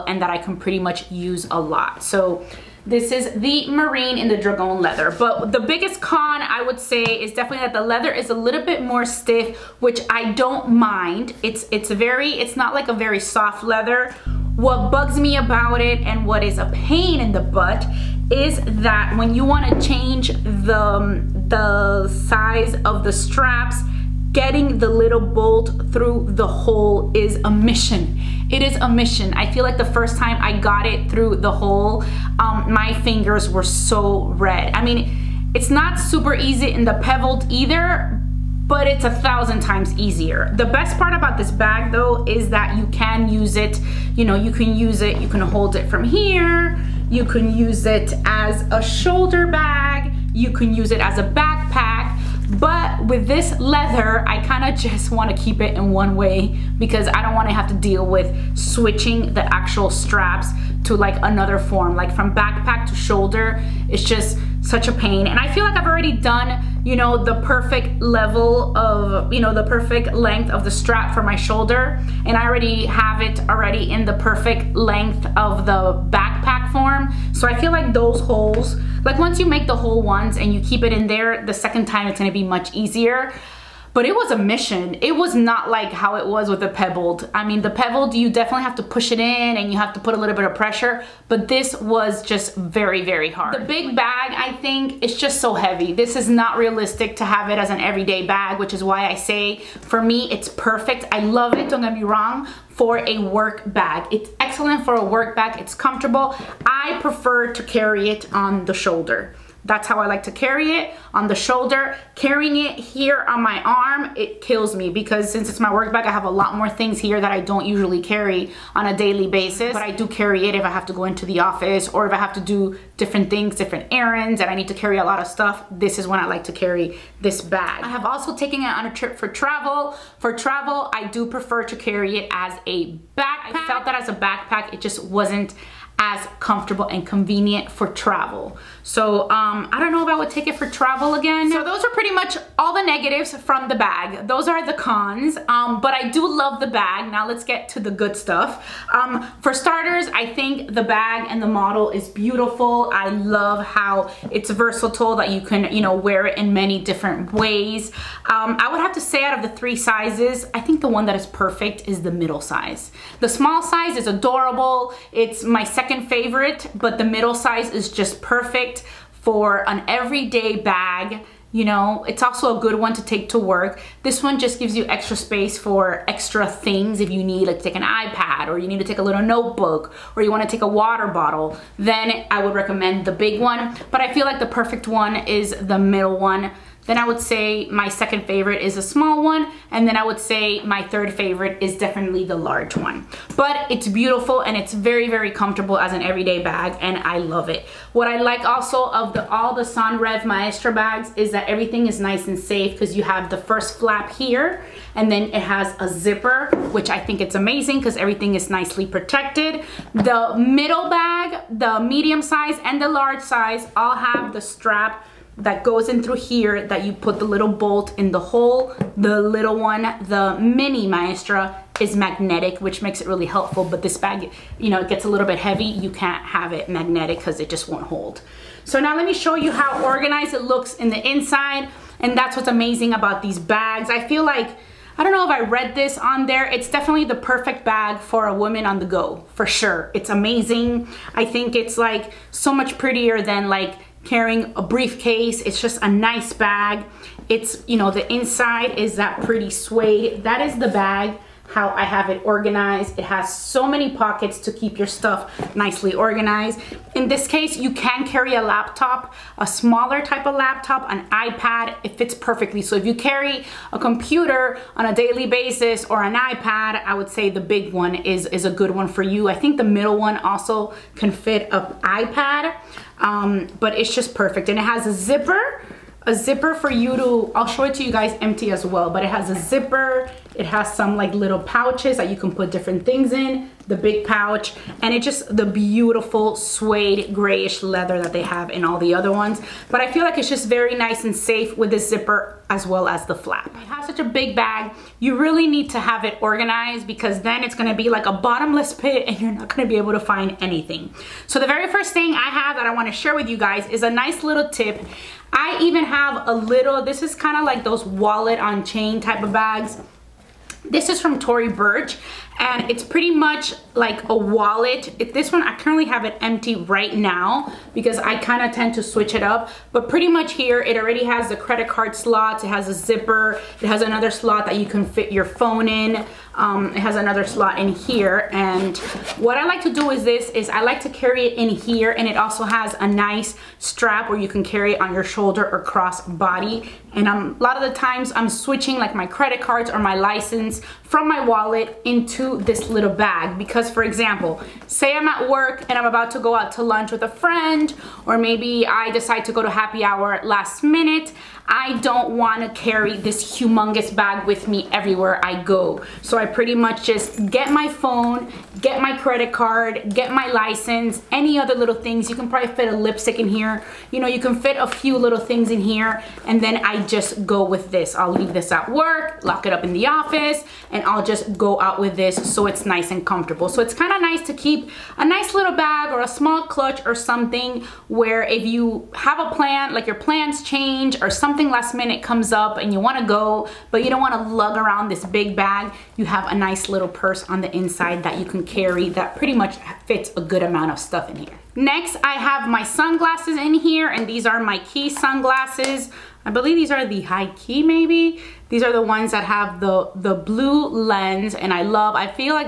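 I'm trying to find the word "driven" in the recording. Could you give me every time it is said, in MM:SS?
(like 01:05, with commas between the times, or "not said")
not said.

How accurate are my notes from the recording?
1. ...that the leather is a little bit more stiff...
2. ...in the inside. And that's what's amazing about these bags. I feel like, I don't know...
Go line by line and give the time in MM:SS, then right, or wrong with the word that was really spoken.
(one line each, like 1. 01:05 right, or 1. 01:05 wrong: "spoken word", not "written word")
1. 00:07 right
2. 03:50 right.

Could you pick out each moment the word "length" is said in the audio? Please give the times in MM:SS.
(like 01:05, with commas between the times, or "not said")
01:10, 01:14.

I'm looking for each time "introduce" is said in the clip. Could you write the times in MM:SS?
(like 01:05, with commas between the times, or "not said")
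not said.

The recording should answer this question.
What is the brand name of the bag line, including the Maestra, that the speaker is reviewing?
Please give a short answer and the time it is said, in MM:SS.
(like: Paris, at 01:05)
Senreve, at 03:19.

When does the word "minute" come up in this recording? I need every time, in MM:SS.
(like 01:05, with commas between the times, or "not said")
05:50, 06:21.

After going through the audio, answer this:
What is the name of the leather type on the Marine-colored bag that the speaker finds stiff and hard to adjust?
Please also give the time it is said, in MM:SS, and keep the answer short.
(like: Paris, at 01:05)
Dragon, at 00:04.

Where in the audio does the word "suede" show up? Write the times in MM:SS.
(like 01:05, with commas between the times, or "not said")
04:09, 04:46.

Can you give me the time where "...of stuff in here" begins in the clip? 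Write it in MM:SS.
06:30.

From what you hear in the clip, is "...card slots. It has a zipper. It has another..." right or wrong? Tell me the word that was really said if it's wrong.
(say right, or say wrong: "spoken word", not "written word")
right.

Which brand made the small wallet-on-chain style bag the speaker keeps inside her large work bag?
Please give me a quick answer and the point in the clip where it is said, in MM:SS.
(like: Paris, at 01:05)
Tory Burch, at 05:11.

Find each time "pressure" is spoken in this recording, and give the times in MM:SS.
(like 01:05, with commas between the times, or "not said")
01:30.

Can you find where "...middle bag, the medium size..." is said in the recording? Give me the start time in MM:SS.
03:30.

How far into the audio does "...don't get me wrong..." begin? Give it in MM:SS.
01:41.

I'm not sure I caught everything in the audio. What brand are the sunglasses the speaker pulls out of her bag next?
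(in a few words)
Quay.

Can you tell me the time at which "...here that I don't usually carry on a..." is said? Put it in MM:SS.
01:56.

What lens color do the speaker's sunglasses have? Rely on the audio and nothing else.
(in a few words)
Blue.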